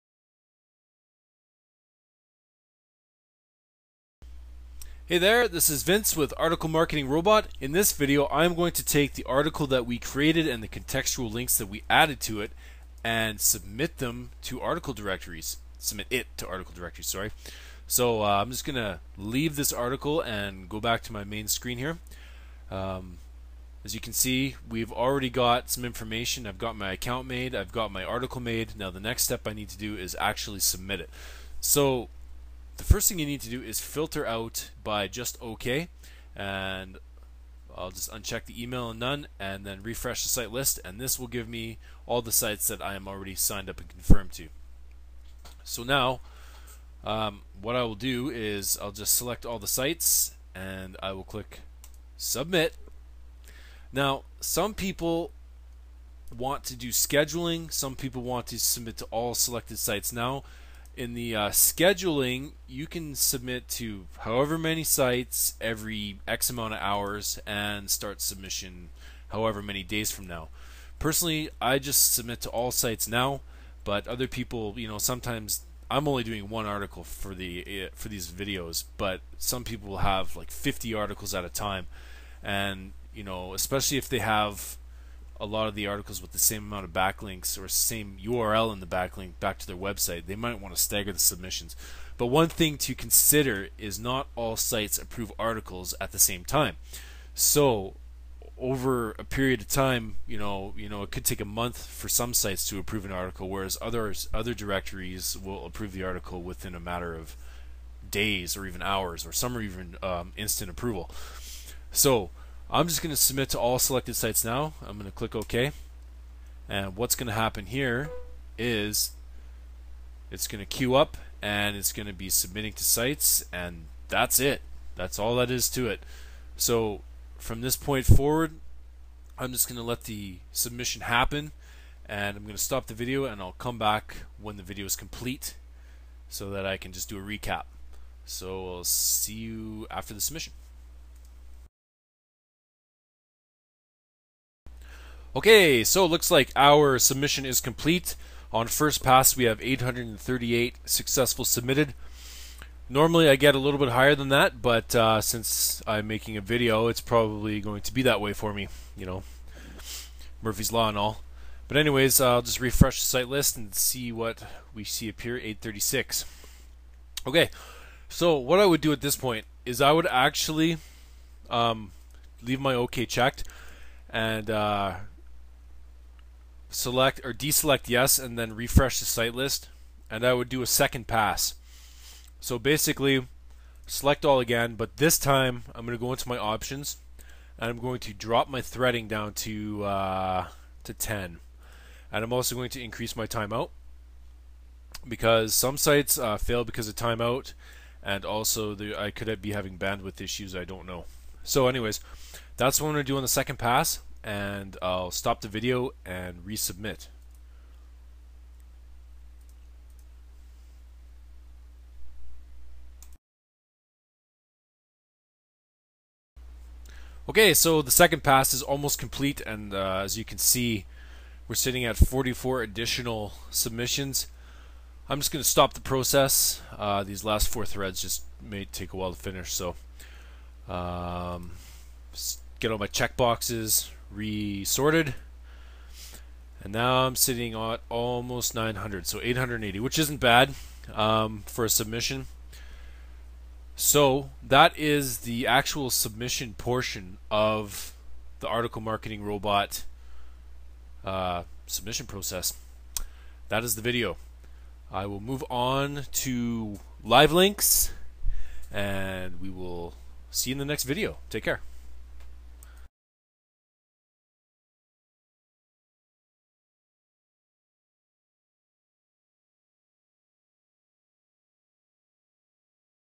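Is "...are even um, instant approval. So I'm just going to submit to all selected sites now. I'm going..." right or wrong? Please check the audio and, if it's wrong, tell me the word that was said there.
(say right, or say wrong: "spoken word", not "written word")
right.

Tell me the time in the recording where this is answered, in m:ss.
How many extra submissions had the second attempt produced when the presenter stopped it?
3:41.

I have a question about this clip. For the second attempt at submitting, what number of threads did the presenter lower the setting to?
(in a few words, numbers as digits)
10.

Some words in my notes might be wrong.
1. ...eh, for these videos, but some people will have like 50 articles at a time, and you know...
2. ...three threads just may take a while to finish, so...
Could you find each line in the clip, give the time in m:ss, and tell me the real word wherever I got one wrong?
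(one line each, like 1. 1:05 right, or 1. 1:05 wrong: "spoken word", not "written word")
1. 1:17 right
2. 3:47 wrong: "four", not "three".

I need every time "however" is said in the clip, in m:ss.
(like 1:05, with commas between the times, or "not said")
1:04, 1:09.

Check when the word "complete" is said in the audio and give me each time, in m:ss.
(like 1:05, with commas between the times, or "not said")
2:14, 2:27, 3:38.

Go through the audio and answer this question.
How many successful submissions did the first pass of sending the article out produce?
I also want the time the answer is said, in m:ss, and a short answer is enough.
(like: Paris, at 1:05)
838, at 2:29.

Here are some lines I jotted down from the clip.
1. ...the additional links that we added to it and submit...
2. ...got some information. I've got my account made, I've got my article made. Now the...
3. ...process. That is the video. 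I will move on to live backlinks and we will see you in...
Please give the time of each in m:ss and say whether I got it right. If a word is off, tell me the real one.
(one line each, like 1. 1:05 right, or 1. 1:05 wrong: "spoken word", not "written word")
1. 0:10 wrong: "contextual", not "additional"
2. 0:25 right
3. 4:12 wrong: "links", not "backlinks".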